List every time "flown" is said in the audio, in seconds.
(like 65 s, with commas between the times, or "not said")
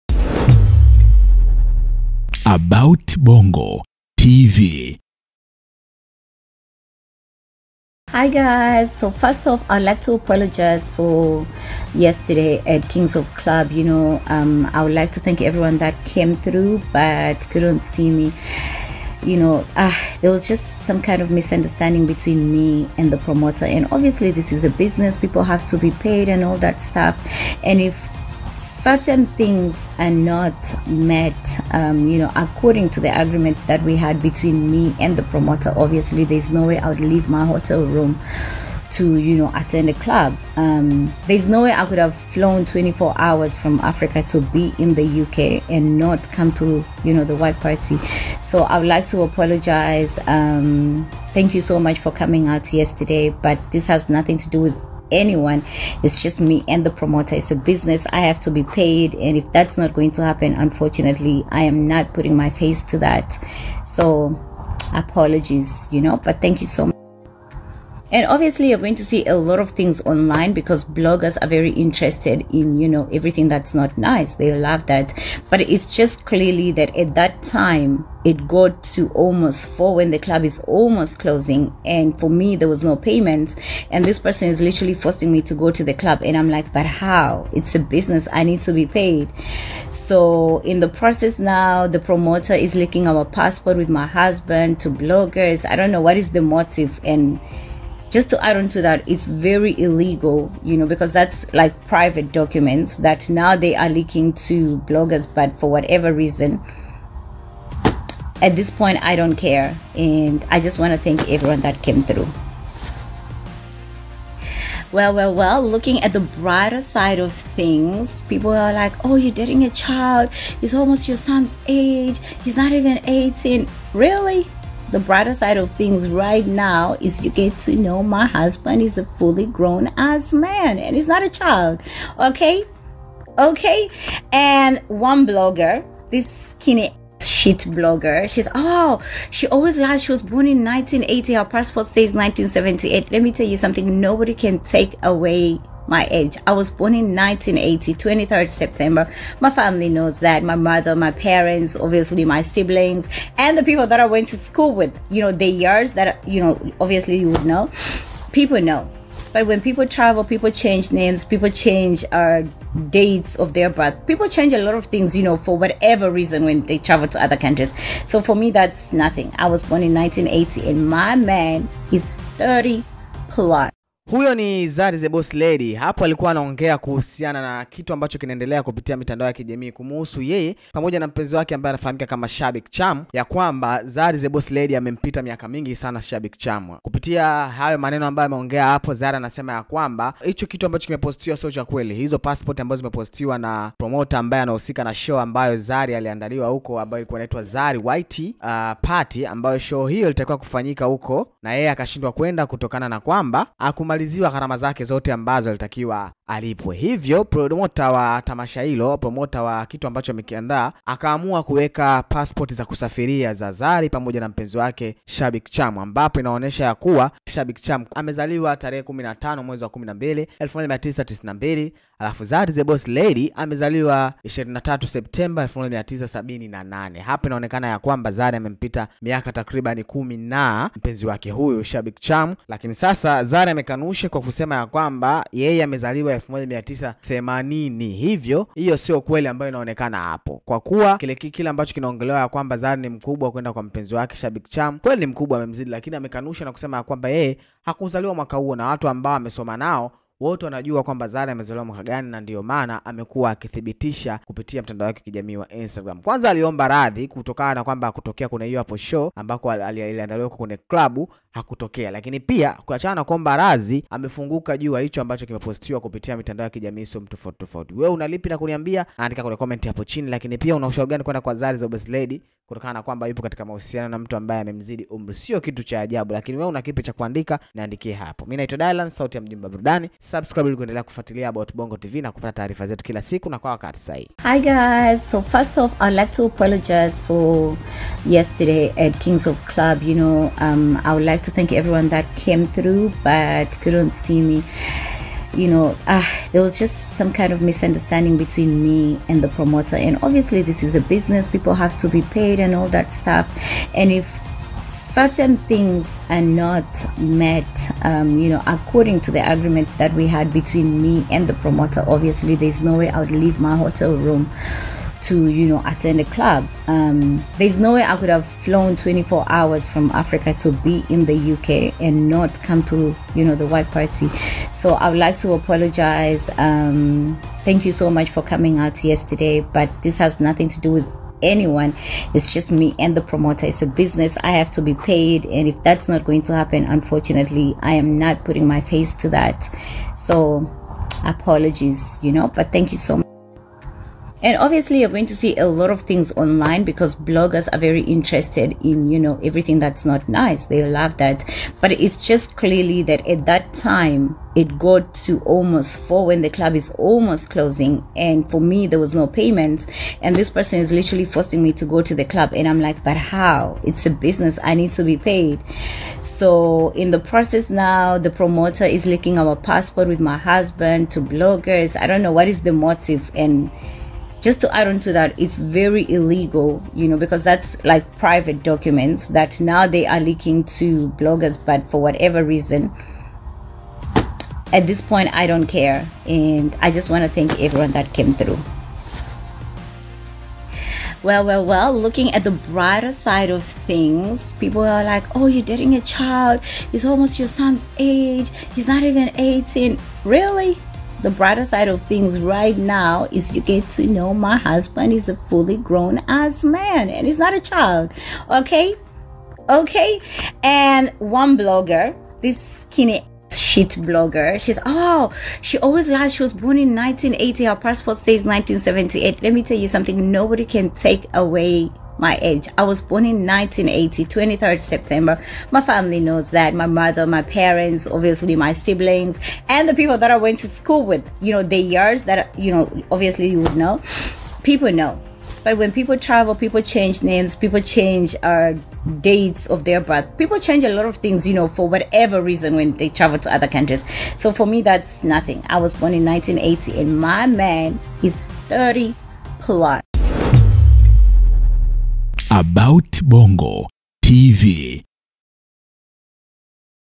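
42 s, 318 s.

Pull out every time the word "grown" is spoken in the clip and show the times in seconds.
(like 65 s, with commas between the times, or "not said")
129 s, 405 s.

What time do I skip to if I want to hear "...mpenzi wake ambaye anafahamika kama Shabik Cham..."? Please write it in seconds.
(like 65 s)
181 s.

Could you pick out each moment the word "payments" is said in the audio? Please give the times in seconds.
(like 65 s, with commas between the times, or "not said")
82 s, 359 s.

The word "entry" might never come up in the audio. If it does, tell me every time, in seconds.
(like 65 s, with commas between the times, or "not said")
not said.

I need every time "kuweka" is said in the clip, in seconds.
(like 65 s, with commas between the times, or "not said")
211 s.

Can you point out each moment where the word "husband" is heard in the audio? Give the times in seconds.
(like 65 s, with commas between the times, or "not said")
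94 s, 128 s, 370 s, 404 s.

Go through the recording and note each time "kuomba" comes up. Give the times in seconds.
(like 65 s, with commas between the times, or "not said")
263 s.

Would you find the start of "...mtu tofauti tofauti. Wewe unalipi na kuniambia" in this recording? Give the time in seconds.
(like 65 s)
266 s.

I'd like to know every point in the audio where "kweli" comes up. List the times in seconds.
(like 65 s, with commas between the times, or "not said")
191 s, 239 s, 244 s.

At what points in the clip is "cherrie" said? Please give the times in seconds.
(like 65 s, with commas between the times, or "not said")
not said.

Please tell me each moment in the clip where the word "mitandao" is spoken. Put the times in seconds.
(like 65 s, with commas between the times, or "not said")
178 s, 266 s.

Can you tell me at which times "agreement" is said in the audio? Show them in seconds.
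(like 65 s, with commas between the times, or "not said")
33 s, 309 s.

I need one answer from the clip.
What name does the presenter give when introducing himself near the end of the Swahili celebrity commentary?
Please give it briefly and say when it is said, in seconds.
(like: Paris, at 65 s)
Dylan, at 278 s.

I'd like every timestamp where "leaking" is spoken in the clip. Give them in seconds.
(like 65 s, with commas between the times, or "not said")
92 s, 103 s, 368 s, 379 s.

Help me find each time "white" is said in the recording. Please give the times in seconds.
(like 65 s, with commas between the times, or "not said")
47 s, 197 s, 323 s.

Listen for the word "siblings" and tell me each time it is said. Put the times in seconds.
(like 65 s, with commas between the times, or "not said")
152 s, 428 s.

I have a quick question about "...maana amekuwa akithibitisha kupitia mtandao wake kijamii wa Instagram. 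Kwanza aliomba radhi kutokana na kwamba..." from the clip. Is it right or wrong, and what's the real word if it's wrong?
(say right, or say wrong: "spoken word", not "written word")
right.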